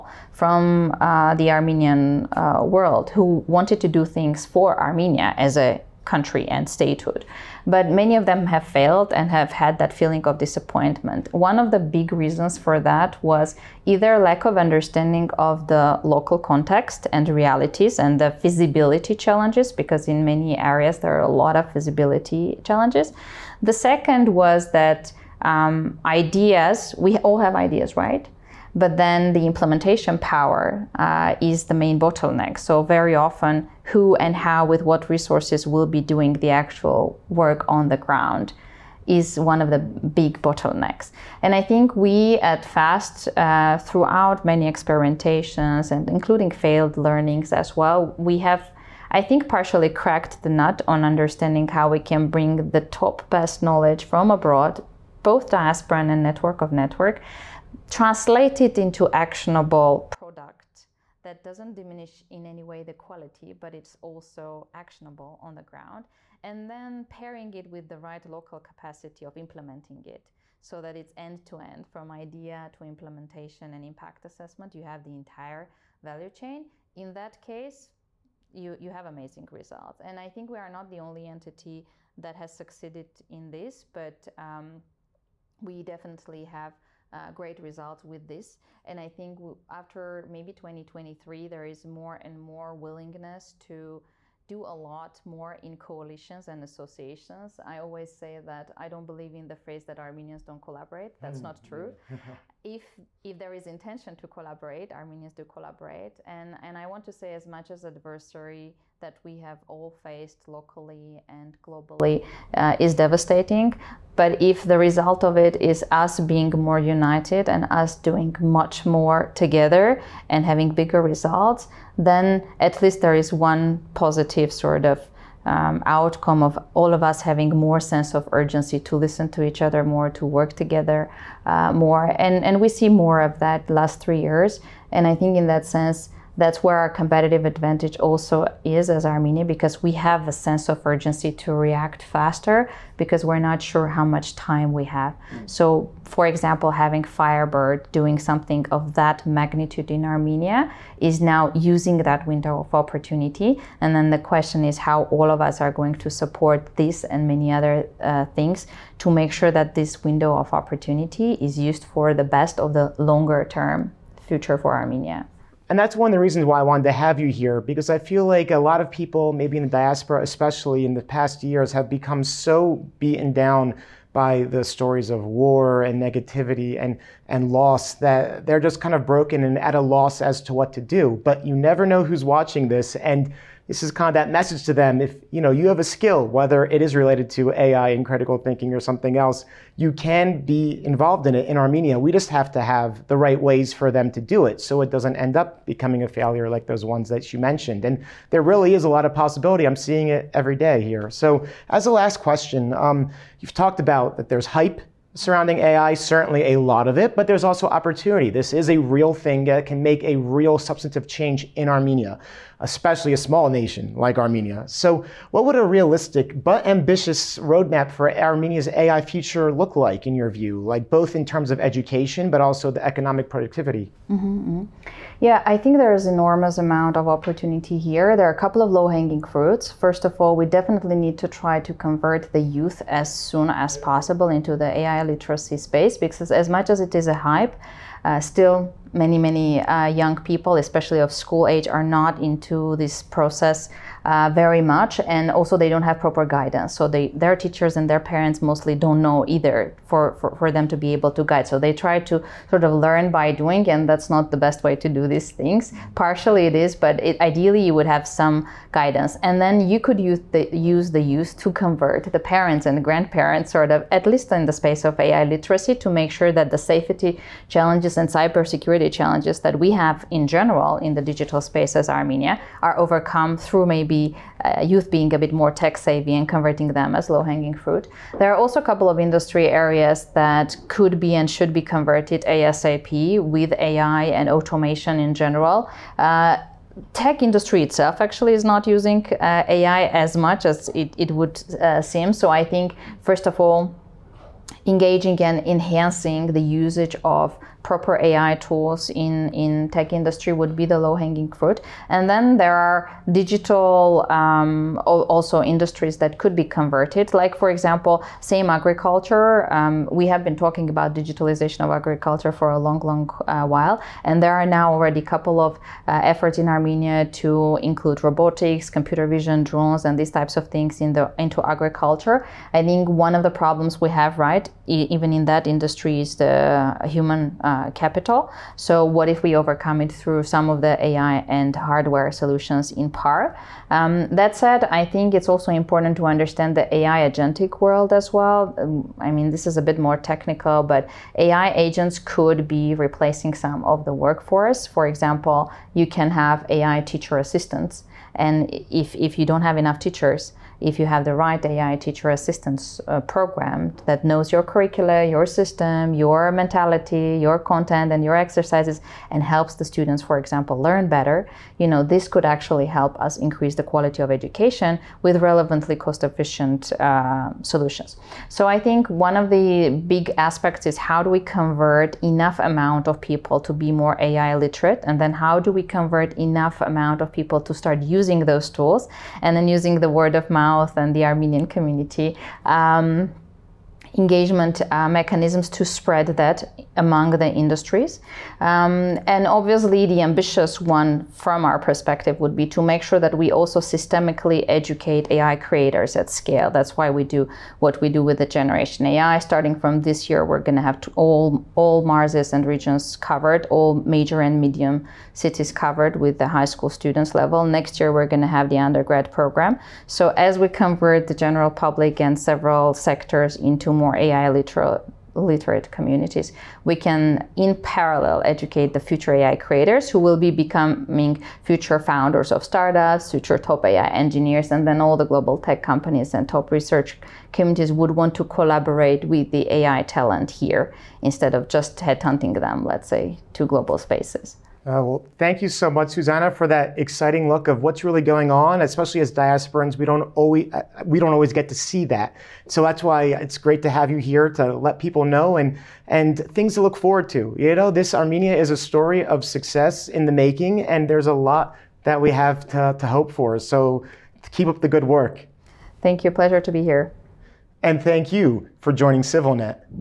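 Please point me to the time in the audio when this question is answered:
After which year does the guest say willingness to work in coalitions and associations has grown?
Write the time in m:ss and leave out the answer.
1:30.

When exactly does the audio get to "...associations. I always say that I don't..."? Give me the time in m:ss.
1:36.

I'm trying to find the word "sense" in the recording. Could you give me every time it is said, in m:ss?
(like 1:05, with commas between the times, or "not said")
2:07, 2:15, 2:20.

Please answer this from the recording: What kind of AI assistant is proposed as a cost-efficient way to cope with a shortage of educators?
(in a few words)
AI teacher assistants.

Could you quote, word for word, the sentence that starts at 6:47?
Next year, we're going to have the undergrad program.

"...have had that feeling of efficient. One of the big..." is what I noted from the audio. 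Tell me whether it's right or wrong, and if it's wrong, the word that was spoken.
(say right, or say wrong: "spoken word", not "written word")
wrong: "disappointment", not "efficient".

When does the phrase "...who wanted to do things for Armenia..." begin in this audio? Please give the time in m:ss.
0:03.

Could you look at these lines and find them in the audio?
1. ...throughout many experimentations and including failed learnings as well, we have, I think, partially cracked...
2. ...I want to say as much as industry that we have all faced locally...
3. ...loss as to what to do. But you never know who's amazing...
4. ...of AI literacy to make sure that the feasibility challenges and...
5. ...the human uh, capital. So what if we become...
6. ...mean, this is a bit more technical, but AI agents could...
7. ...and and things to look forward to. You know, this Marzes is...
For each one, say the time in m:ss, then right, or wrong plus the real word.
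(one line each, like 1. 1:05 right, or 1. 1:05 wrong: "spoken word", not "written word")
1. 0:43 right
2. 1:46 wrong: "adversary", not "industry"
3. 2:59 wrong: "watching", not "amazing"
4. 4:24 wrong: "safety", not "feasibility"
5. 5:26 wrong: "overcome", not "become"
6. 5:39 right
7. 7:25 wrong: "Armenia", not "Marzes".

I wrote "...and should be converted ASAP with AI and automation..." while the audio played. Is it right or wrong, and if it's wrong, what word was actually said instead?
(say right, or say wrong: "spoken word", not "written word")
right.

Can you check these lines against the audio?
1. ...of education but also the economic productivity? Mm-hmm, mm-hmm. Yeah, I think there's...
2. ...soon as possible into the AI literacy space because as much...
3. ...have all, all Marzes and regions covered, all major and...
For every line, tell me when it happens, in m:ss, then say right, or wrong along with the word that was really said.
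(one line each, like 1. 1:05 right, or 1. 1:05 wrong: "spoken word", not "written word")
1. 3:41 right
2. 3:53 right
3. 6:40 right.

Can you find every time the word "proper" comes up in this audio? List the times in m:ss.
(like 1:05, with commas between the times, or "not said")
4:05, 4:57.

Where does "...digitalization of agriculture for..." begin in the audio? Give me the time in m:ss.
5:10.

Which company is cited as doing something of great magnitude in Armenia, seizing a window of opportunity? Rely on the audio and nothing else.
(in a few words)
Firebird.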